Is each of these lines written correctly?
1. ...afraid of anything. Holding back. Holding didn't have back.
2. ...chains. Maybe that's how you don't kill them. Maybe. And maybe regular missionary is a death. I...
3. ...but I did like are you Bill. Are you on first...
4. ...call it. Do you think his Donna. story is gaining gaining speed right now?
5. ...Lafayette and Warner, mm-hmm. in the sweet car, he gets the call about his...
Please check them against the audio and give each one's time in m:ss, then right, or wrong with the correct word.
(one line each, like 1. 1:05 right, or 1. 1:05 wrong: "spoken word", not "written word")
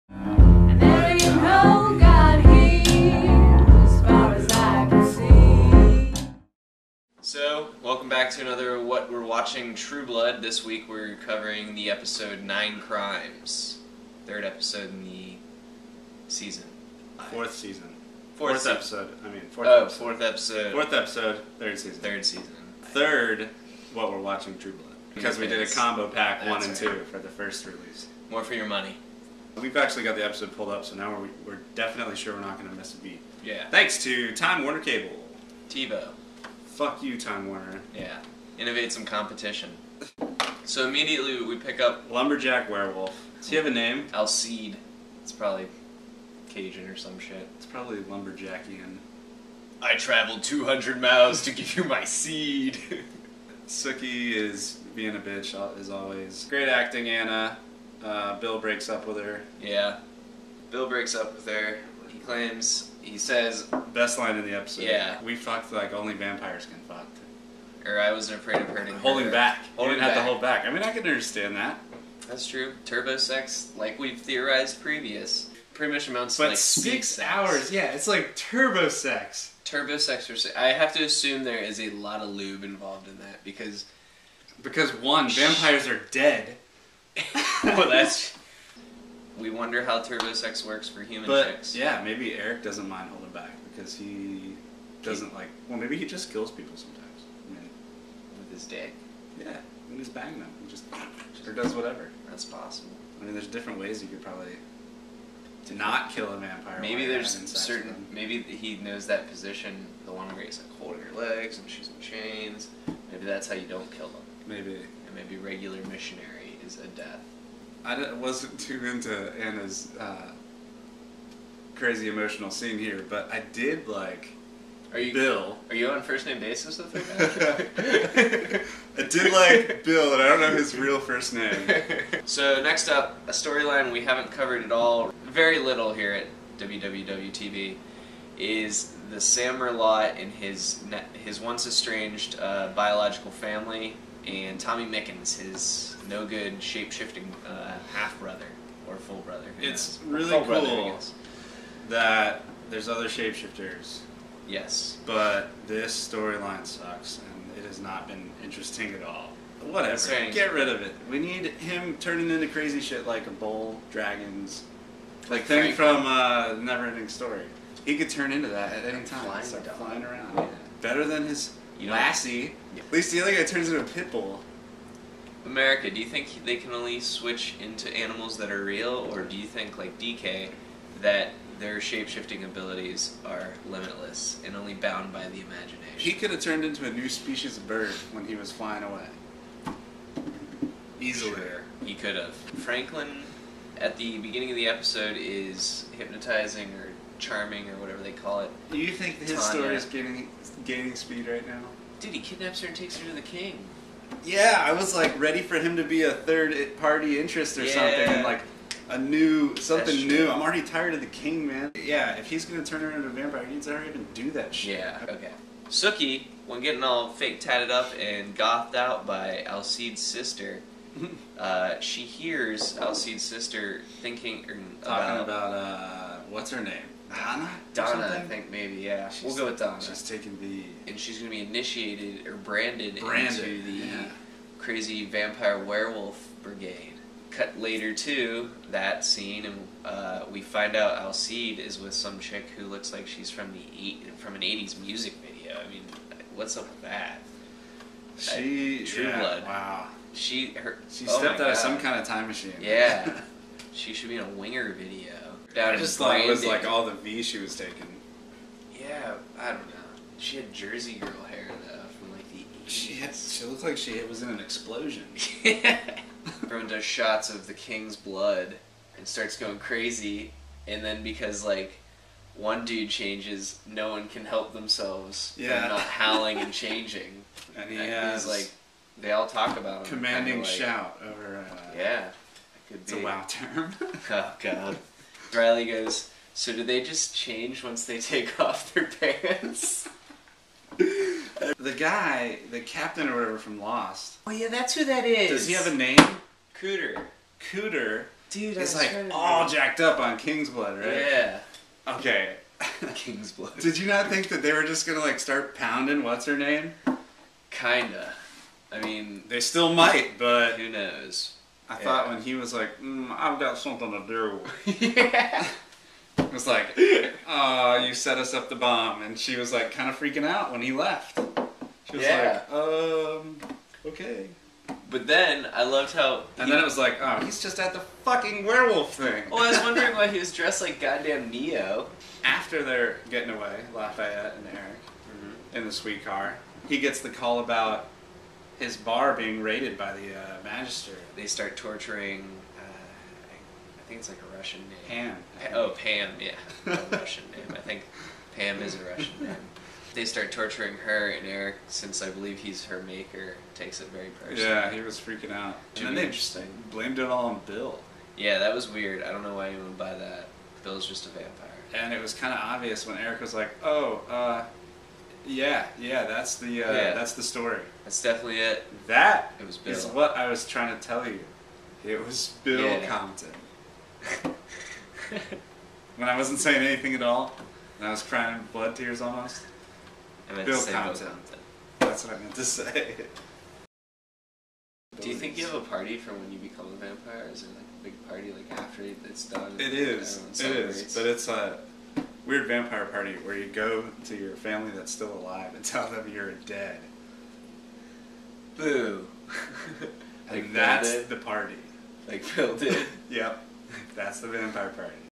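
1. 1:08 wrong: "hurting", not "anything"
2. 1:52 right
3. 2:03 right
4. 3:18 wrong: "Tanya", not "Donna"
5. 5:33 wrong: "Eric", not "Warner".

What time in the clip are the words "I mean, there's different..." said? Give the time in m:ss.
1:43.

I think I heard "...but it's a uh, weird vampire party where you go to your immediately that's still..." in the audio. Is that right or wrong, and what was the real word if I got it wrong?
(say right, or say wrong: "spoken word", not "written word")
wrong: "family", not "immediately".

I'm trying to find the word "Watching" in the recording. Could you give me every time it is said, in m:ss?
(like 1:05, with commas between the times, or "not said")
0:09, 0:24.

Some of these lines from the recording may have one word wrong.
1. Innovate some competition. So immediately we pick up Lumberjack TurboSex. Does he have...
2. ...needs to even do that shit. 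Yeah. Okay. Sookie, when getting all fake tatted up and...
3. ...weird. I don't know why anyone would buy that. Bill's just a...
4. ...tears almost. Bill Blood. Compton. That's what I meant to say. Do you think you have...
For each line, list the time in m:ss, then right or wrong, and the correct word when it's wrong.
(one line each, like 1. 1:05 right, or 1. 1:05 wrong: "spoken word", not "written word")
1. 0:38 wrong: "Werewolf", not "TurboSex"
2. 3:33 right
3. 5:58 right
4. 6:18 wrong: "Compton", not "Blood".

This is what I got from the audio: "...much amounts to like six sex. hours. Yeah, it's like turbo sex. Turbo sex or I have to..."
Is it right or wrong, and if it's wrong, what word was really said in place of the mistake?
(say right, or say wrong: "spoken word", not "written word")
right.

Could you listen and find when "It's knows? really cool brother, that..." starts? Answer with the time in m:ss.
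2:29.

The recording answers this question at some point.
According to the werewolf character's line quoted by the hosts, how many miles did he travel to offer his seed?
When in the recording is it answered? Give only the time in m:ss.
0:50.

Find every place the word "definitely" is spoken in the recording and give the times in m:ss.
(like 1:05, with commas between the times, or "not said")
0:31, 6:08.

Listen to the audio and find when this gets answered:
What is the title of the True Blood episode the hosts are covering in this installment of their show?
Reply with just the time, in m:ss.
0:12.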